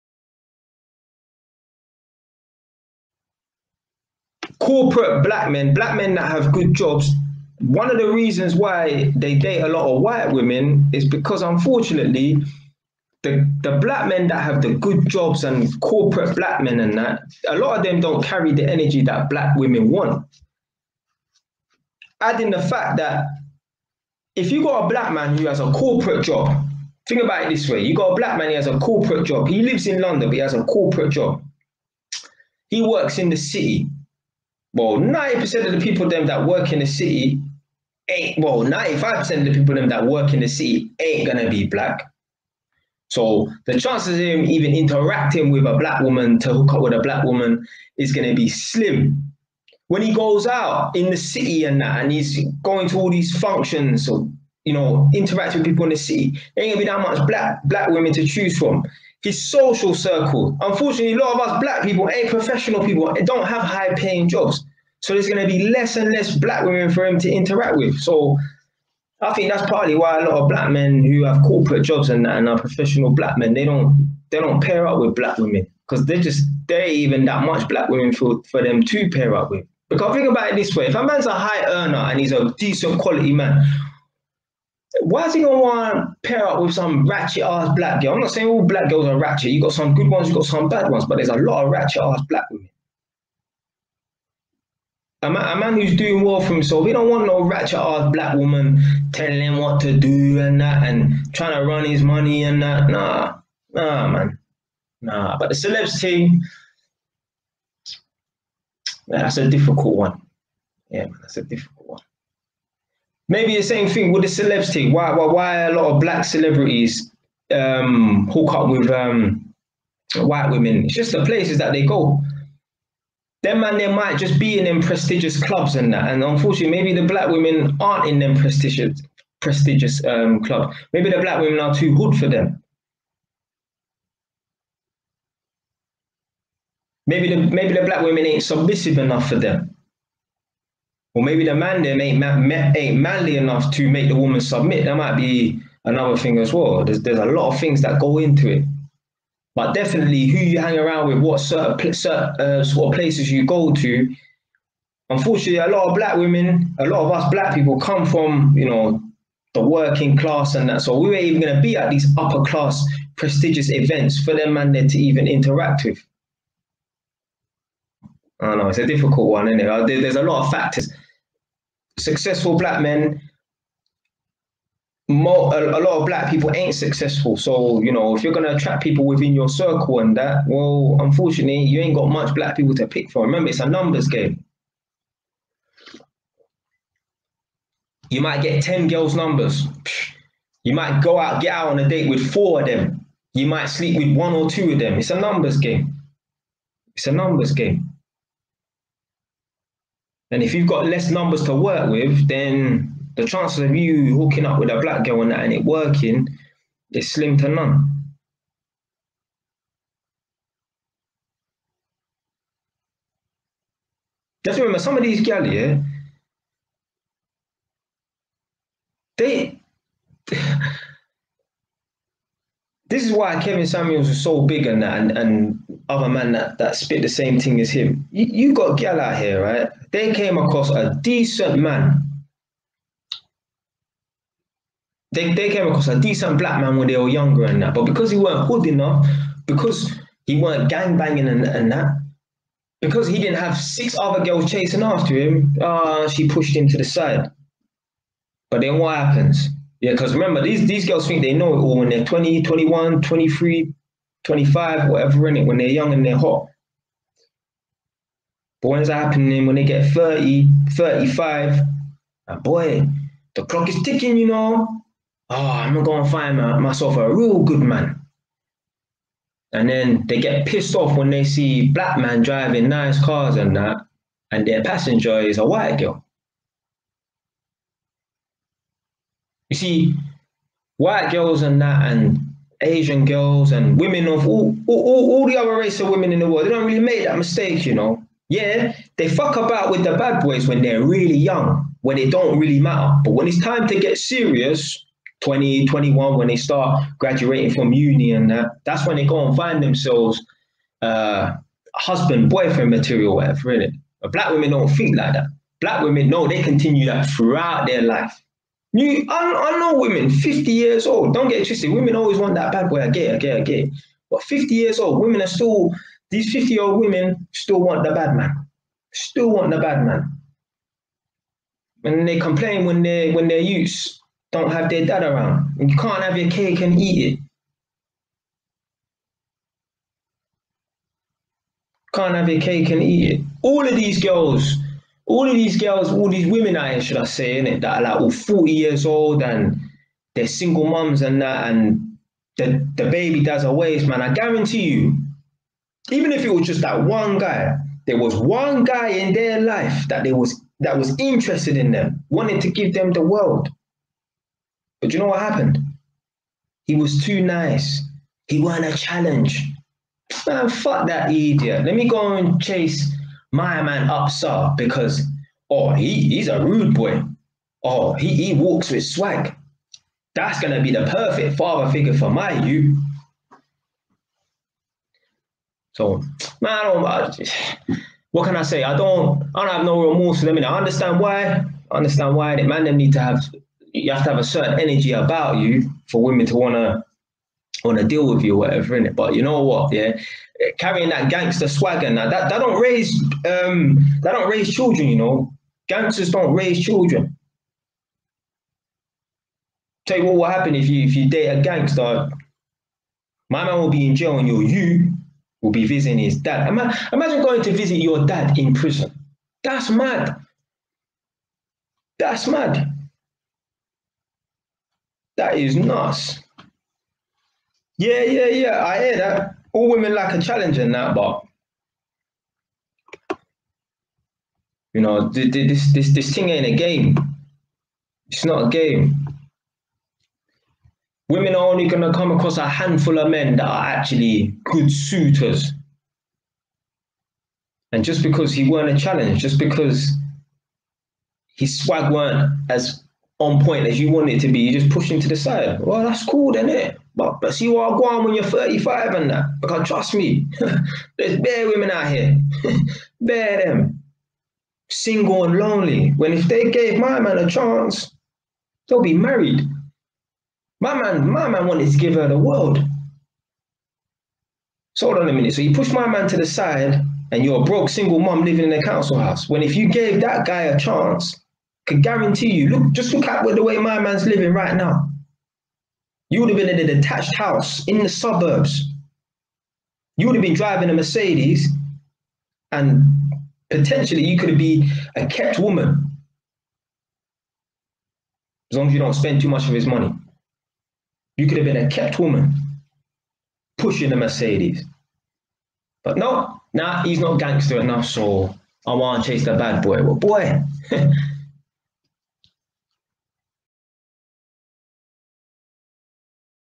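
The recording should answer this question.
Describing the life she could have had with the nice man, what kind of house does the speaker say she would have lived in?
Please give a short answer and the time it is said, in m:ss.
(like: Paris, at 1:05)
Detached house, at 7:56.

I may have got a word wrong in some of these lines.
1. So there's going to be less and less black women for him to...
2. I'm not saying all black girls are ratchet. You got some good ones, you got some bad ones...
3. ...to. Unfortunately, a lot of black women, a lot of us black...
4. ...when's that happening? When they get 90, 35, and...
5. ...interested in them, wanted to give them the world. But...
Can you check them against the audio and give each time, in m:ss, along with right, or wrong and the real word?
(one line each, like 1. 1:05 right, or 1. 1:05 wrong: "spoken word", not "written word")
1. 1:05 right
2. 1:28 right
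3. 2:33 right
4. 4:18 wrong: "30", not "90"
5. 5:50 right.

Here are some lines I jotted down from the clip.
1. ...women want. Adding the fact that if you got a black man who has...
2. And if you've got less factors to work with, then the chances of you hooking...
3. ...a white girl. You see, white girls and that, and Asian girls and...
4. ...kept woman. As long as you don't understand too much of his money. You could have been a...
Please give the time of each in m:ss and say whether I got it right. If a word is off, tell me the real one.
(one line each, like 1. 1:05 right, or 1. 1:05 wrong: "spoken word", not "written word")
1. 0:19 right
2. 3:20 wrong: "numbers", not "factors"
3. 4:35 right
4. 8:05 wrong: "spend", not "understand".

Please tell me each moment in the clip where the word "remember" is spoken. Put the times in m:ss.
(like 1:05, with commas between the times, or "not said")
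3:03, 3:34, 4:10.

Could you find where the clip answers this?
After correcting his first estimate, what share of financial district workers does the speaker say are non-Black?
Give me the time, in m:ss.
0:38.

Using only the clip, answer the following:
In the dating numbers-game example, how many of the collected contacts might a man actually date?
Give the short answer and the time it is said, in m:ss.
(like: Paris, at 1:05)
4, at 3:12.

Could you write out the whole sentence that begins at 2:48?
I know it's a difficult one, isn't it?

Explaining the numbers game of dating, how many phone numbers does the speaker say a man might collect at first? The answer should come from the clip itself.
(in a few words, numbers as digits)
10.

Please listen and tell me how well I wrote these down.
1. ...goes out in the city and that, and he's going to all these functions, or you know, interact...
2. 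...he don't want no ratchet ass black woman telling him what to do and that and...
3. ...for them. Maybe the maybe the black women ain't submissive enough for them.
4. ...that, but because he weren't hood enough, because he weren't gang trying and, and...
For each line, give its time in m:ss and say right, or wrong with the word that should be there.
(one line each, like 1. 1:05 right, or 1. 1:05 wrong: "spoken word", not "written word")
1. 0:50 right
2. 1:36 right
3. 2:12 right
4. 3:57 wrong: "banging", not "trying".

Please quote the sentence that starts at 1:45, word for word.
Nah, but the celebs team, that's a difficult one.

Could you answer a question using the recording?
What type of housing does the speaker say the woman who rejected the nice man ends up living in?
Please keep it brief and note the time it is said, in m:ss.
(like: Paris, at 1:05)
Council house, at 7:48.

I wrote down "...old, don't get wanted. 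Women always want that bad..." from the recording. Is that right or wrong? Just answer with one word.
wrong.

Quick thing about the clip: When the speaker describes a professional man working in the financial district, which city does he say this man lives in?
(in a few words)
London.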